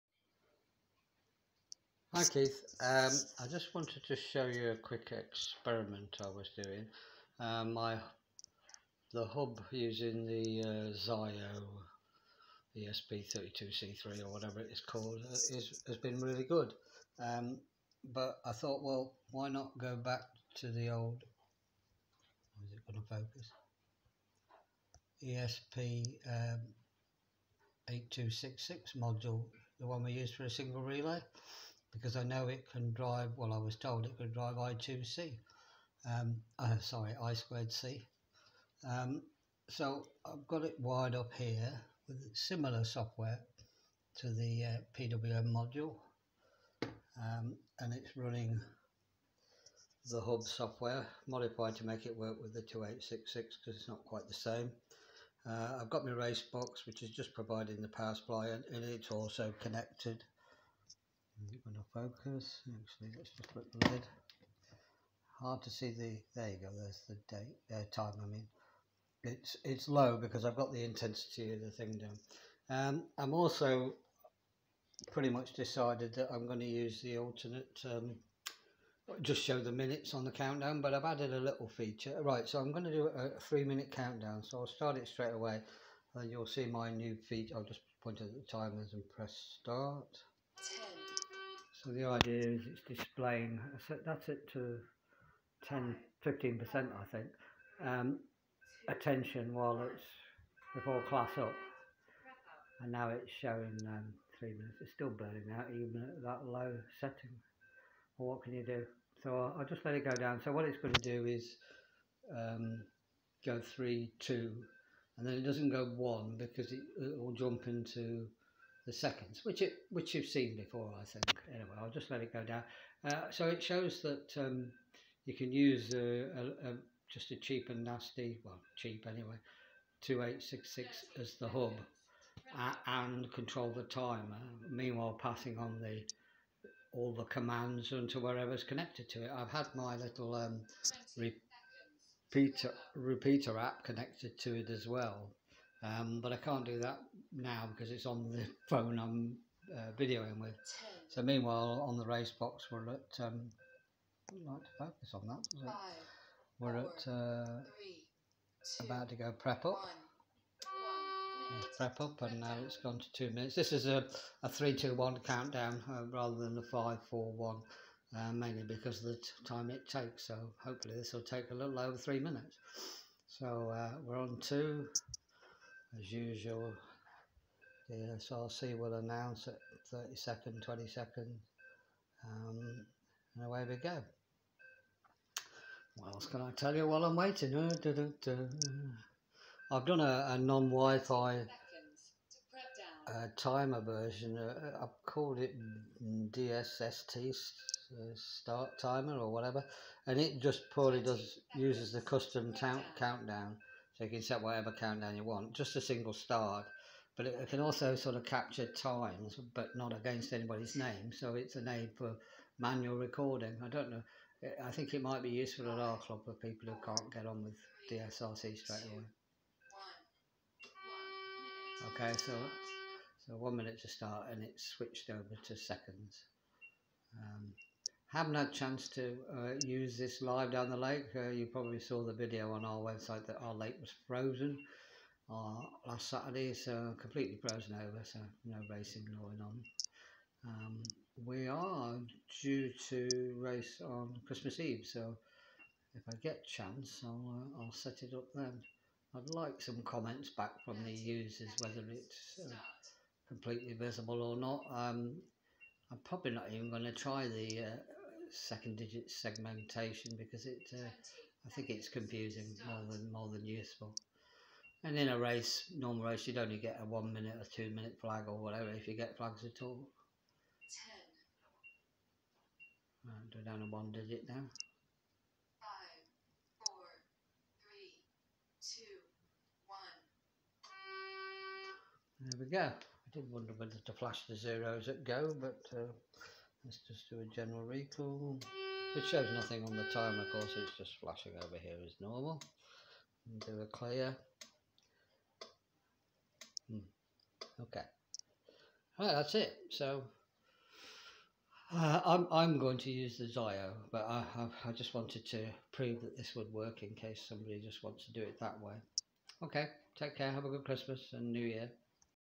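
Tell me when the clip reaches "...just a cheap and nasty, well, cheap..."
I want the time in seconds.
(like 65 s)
127 s.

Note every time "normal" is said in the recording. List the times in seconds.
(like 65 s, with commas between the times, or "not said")
265 s, 291 s.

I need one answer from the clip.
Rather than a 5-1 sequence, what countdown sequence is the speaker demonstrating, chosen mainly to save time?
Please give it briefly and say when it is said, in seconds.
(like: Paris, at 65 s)
3 1, at 164 s.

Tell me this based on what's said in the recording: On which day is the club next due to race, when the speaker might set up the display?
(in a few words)
Christmas Eve.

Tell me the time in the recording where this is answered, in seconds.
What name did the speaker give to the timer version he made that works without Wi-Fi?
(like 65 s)
196 s.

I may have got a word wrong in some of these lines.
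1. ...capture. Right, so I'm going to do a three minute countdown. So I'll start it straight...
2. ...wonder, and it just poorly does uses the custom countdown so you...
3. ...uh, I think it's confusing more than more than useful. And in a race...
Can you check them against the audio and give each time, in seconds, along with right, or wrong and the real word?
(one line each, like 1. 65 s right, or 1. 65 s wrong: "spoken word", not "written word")
1. 81 s wrong: "feature", not "capture"
2. 199 s wrong: "whatever", not "wonder"
3. 260 s right.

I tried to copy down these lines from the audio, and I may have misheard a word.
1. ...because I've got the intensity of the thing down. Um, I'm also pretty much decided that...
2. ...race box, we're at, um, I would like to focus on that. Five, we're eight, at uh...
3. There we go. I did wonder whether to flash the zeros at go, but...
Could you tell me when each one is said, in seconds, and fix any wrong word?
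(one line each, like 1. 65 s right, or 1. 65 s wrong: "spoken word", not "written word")
1. 70 s right
2. 152 s wrong: "four", not "eight"
3. 282 s right.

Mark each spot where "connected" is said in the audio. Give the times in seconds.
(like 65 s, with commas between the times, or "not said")
59 s, 138 s, 143 s.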